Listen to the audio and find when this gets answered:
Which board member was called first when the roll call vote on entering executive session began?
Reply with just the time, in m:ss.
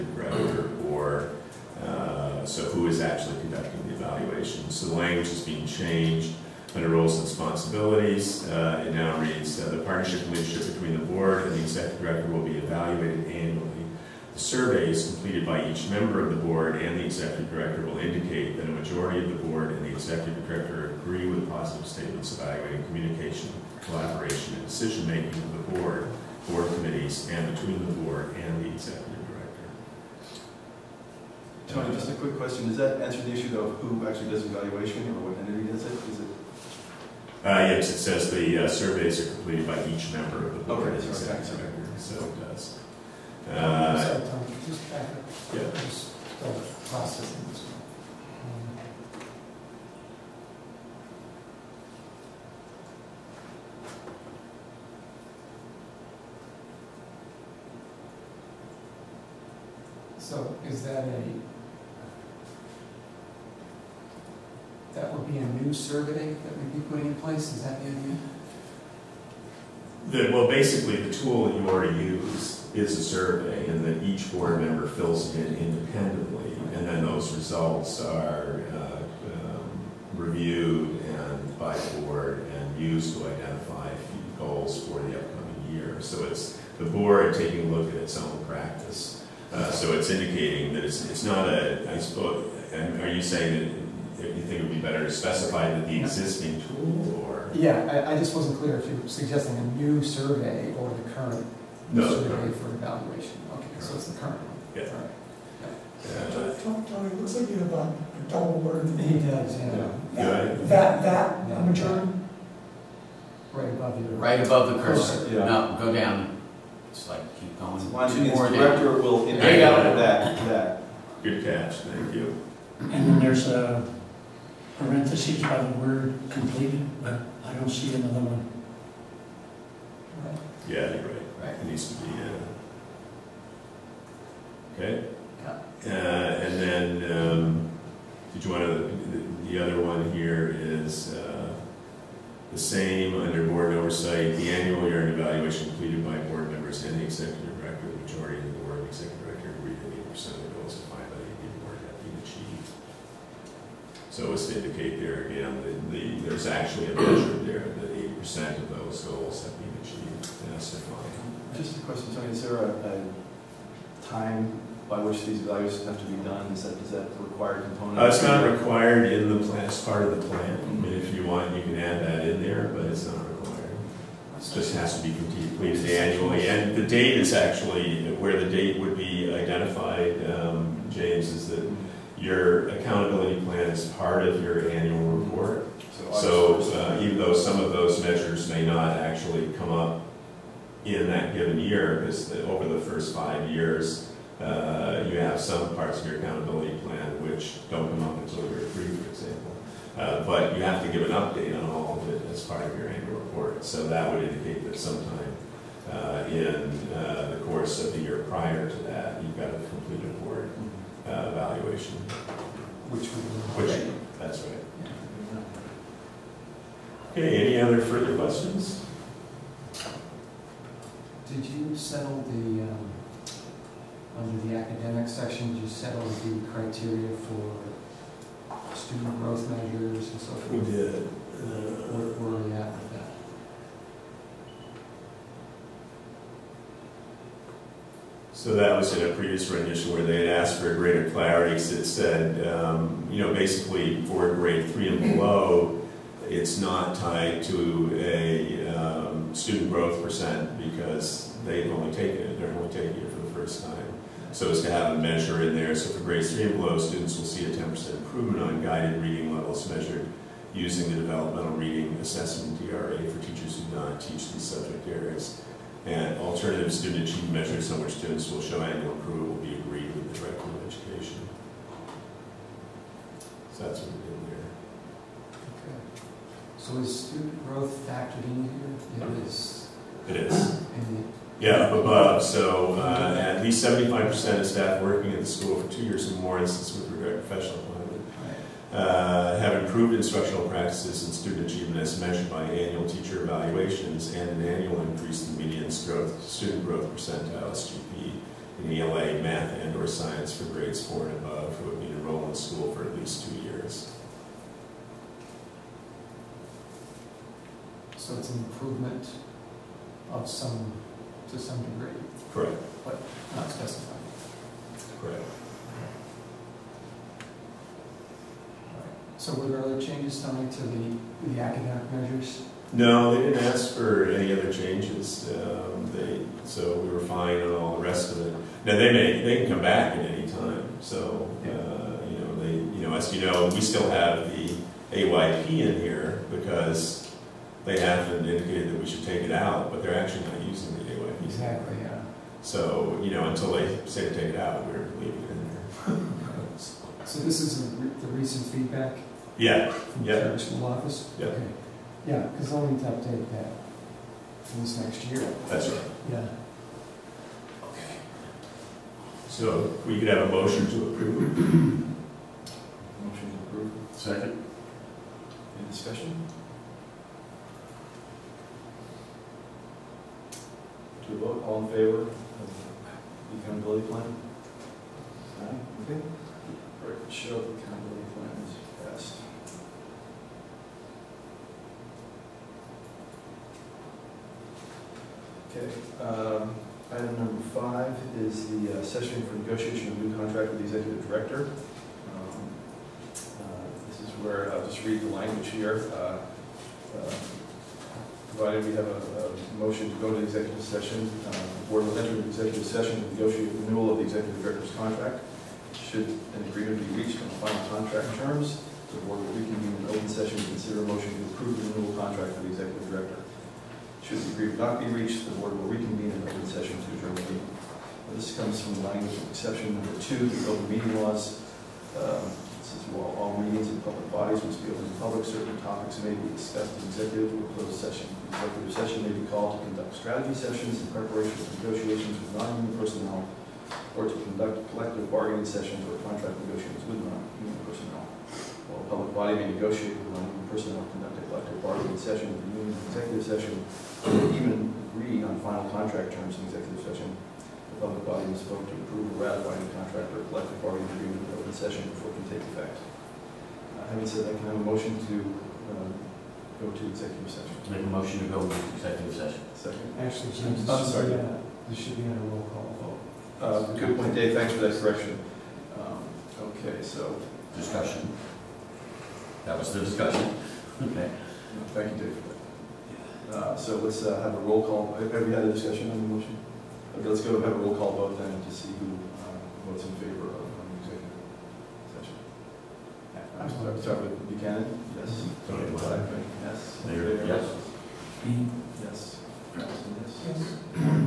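8:04.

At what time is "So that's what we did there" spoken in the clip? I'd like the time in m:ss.
4:33.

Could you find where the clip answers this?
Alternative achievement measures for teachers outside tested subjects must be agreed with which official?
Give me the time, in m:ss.
4:30.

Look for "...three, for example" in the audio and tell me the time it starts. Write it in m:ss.
3:18.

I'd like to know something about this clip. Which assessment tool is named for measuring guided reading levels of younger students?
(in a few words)
Developmental Reading Assessment (DRA).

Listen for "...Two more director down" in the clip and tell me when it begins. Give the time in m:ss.
1:58.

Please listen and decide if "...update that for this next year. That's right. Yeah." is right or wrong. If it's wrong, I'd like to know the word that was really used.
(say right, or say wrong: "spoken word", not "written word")
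right.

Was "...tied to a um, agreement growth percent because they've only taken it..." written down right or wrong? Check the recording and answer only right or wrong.
wrong.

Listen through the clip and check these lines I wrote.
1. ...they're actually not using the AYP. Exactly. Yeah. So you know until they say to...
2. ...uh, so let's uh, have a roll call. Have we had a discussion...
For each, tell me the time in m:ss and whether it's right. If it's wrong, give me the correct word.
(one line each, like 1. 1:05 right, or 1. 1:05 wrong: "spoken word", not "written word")
1. 5:39 right
2. 7:53 right.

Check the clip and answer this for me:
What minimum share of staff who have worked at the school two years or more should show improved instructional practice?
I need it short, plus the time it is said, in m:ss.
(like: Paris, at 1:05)
75%, at 4:43.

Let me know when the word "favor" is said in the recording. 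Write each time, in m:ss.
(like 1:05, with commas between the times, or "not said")
6:11, 7:59.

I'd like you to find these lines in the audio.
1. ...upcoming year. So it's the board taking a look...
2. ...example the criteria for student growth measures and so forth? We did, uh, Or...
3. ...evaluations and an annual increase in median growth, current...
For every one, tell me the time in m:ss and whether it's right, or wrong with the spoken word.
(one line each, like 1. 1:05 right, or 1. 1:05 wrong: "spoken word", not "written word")
1. 1:25 right
2. 3:45 wrong: "settle", not "example"
3. 4:53 wrong: "student", not "current".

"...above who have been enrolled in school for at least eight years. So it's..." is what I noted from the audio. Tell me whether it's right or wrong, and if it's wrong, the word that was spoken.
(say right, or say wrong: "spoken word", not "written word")
wrong: "two", not "eight".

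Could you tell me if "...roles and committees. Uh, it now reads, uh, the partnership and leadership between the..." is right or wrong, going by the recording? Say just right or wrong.
wrong.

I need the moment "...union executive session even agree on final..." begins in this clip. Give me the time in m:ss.
7:22.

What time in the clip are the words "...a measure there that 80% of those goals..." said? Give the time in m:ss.
2:36.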